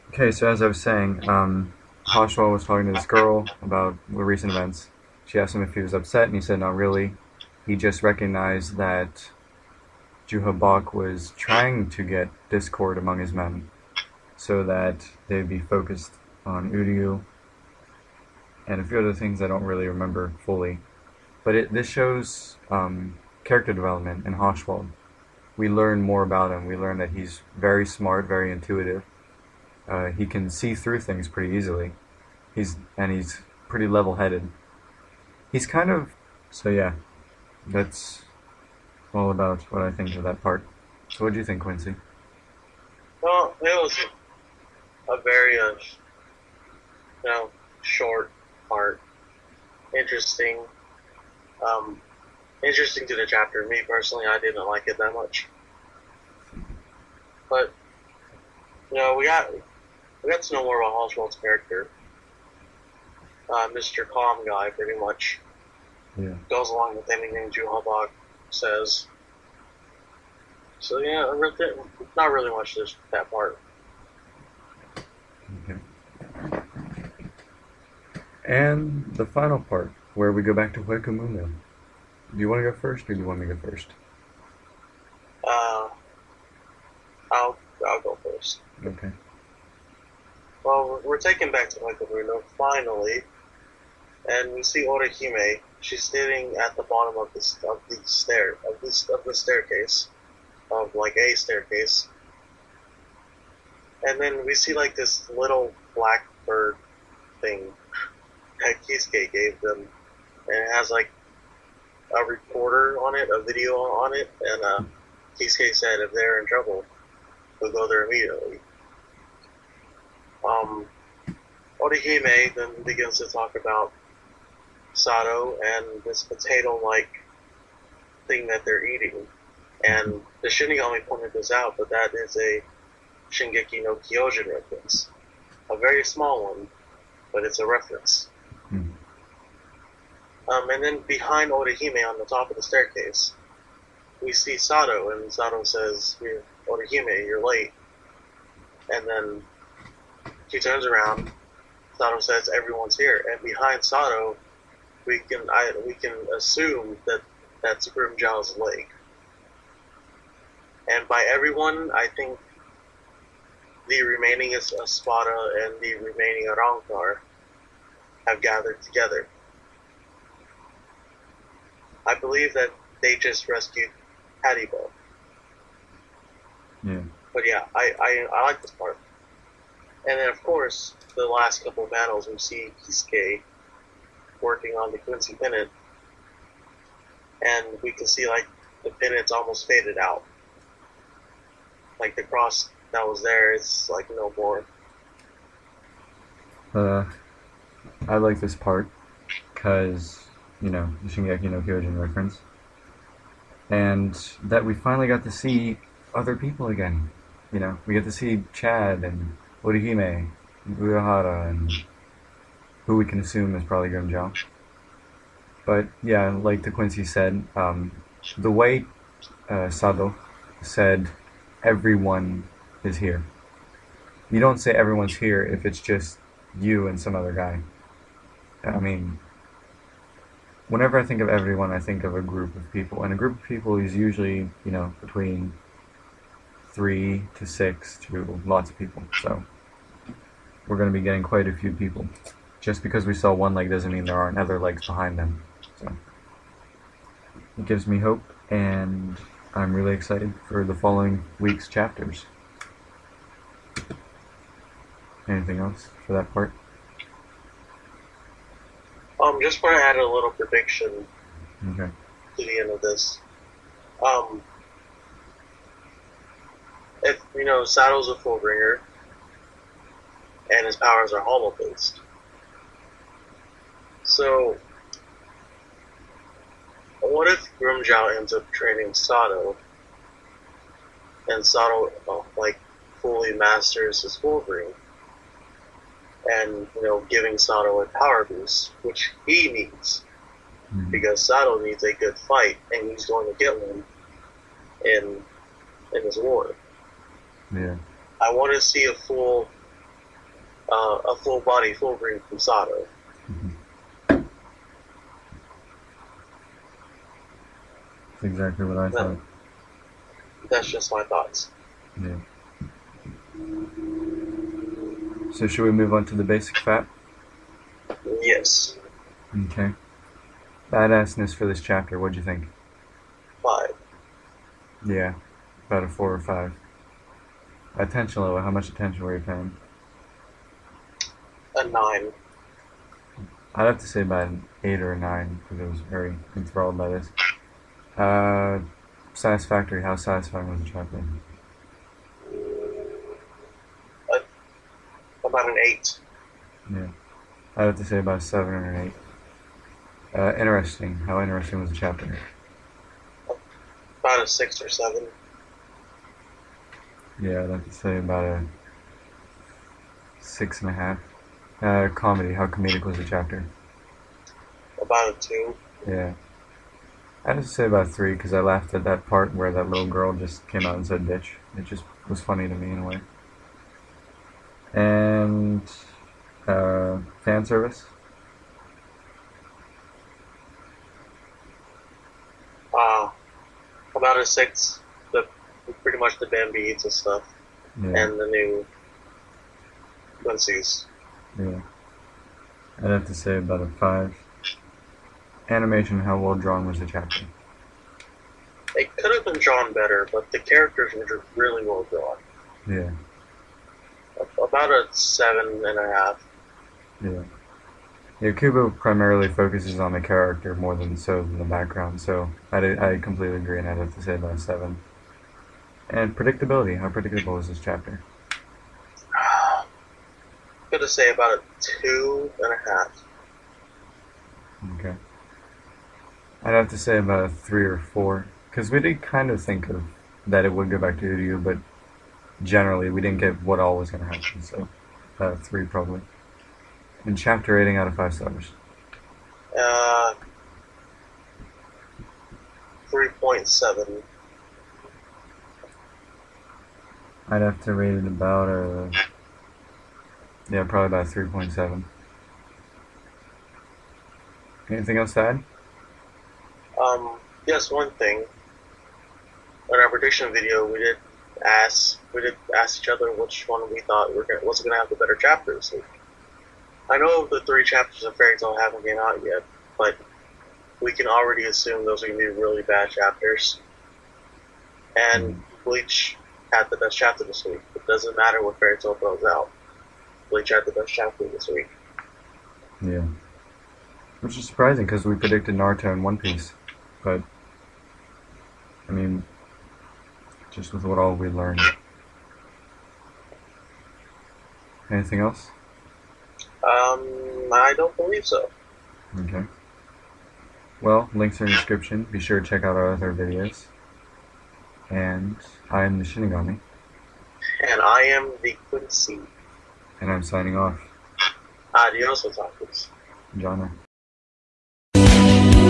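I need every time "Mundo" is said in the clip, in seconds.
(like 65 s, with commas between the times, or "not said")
81 s, 92 s.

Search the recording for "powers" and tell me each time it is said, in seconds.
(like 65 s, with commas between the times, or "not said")
270 s, 287 s.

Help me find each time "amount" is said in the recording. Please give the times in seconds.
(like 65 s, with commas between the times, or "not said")
not said.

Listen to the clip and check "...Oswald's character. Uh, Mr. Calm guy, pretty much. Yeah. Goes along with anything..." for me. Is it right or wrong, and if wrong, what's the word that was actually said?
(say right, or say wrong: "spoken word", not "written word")
right.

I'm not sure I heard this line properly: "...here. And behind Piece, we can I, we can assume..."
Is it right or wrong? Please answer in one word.
wrong.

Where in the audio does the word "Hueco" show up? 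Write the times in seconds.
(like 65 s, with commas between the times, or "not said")
80 s, 91 s.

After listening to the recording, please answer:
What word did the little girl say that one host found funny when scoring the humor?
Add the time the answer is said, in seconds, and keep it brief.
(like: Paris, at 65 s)
bitch, at 371 s.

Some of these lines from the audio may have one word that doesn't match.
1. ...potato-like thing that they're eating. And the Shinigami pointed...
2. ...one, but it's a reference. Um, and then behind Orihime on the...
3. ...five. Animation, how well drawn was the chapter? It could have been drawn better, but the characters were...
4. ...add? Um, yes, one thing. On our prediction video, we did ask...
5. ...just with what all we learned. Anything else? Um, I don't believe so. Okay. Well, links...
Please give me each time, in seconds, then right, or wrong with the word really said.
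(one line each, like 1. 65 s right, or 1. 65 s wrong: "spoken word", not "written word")
1. 126 s right
2. 136 s right
3. 393 s right
4. 455 s right
5. 490 s right.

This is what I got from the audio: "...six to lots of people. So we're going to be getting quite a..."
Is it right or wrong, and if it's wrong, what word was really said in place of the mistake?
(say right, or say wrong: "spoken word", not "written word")
right.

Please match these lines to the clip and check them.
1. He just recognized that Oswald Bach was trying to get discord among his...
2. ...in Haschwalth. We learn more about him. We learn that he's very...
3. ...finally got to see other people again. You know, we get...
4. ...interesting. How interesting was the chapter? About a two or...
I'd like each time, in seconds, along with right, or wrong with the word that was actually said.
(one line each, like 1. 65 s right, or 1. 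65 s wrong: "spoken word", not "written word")
1. 7 s wrong: "Juha", not "Oswald"
2. 24 s right
3. 204 s right
4. 350 s wrong: "six", not "two".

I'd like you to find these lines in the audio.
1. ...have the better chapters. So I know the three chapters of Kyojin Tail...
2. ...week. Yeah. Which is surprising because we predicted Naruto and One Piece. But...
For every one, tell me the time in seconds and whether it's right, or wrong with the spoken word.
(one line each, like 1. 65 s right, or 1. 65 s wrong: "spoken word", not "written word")
1. 464 s wrong: "Fairy", not "Kyojin"
2. 481 s right.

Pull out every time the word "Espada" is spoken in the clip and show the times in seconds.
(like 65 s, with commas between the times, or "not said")
164 s.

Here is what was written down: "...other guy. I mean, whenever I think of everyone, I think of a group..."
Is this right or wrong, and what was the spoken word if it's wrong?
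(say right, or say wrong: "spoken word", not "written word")
right.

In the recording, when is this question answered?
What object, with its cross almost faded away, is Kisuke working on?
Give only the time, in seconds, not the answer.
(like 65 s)
184 s.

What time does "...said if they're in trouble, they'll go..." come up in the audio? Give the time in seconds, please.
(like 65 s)
115 s.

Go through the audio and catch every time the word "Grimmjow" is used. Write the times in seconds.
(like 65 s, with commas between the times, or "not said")
157 s, 213 s, 277 s.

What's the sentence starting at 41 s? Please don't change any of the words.
So what do you think, Quincy?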